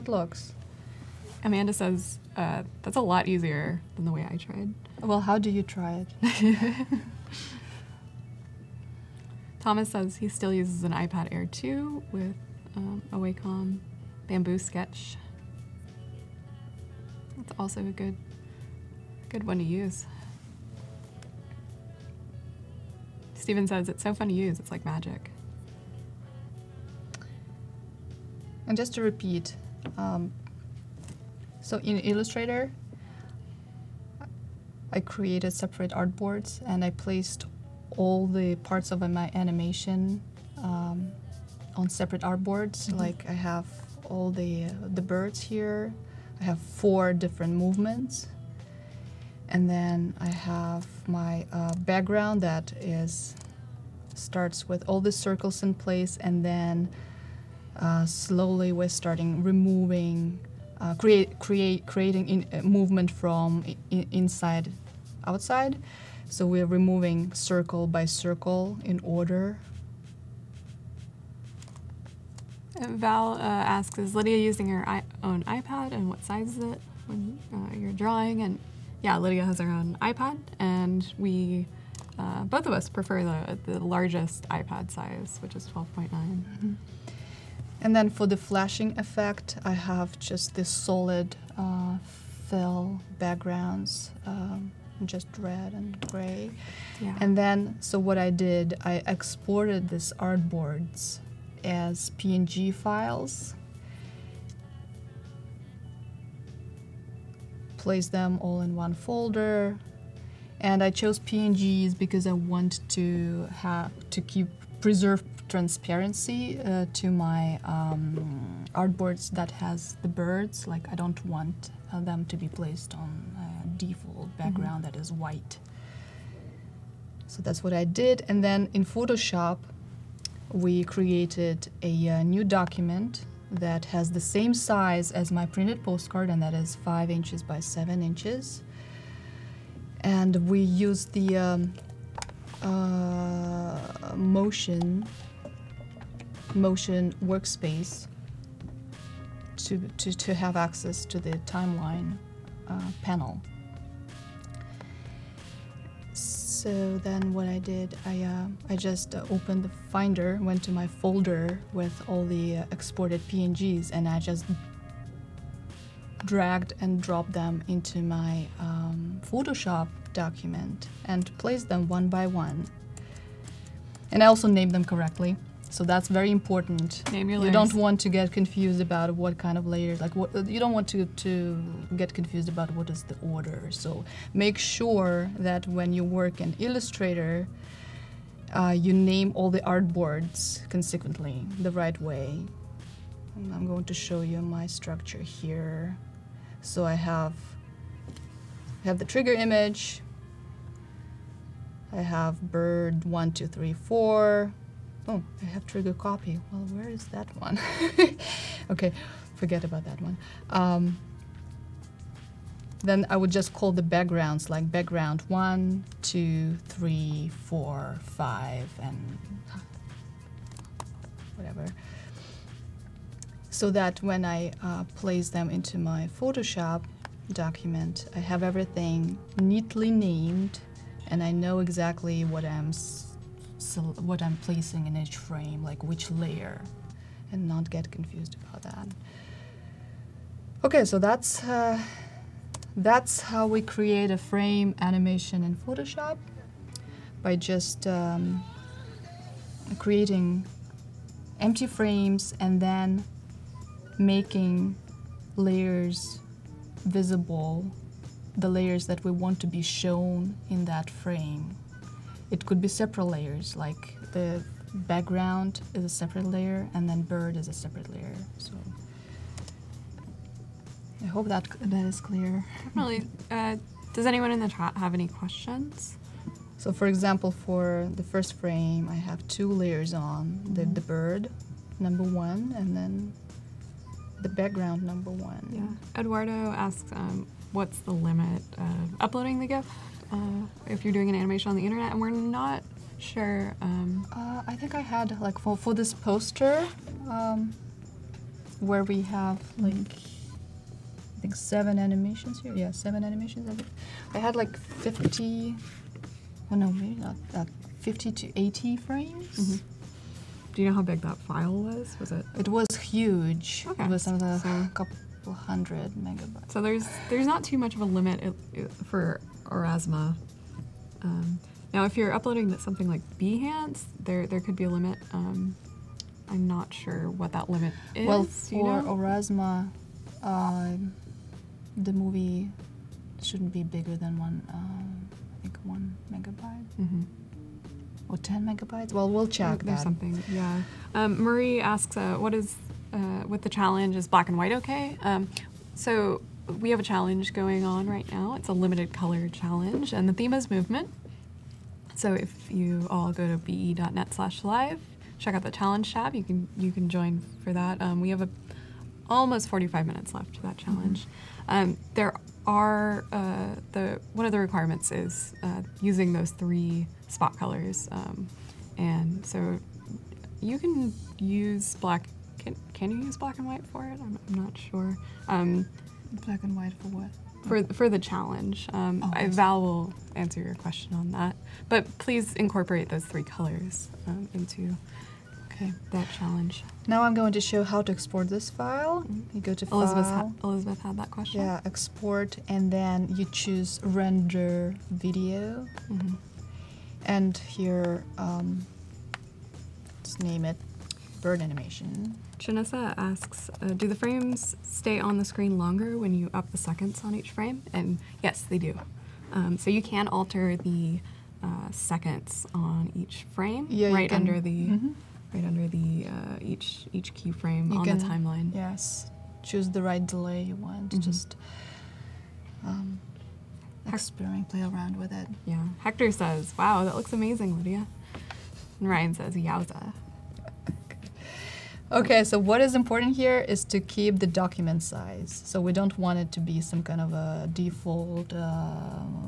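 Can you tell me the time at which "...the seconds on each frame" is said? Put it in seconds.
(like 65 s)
406 s.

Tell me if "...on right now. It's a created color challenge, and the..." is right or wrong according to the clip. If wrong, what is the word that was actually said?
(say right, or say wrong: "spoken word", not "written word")
wrong: "limited", not "created".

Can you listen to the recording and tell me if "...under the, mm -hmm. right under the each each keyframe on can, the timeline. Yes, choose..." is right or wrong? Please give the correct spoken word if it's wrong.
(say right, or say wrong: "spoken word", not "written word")
right.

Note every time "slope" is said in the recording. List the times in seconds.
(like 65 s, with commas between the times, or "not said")
not said.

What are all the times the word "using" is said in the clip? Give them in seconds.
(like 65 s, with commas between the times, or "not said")
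74 s, 365 s.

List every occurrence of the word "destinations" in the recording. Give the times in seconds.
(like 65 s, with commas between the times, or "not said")
not said.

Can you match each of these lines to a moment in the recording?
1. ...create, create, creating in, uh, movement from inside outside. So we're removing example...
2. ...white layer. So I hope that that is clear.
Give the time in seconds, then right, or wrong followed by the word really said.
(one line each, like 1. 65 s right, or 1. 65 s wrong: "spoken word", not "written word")
1. 60 s wrong: "circle", not "example"
2. 267 s wrong: "separate", not "white".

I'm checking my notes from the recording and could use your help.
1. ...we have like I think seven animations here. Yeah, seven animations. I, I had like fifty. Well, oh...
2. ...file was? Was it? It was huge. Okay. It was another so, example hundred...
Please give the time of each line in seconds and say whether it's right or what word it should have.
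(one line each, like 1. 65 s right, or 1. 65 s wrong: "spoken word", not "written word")
1. 298 s right
2. 311 s wrong: "couple", not "example".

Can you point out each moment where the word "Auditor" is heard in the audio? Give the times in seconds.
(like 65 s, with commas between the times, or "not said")
not said.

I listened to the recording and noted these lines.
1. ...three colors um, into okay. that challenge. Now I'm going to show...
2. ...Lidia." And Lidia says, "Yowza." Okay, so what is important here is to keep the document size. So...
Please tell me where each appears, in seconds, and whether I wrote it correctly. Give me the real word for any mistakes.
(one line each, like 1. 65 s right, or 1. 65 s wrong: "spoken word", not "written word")
1. 383 s right
2. 427 s wrong: "Ryan", not "Lidia".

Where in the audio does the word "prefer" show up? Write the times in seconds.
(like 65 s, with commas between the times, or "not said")
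82 s.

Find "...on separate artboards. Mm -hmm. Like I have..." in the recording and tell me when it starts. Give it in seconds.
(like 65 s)
41 s.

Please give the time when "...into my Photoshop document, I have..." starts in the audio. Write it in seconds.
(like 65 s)
225 s.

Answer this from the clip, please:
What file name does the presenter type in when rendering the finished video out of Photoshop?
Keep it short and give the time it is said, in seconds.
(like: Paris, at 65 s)
bird animation, at 401 s.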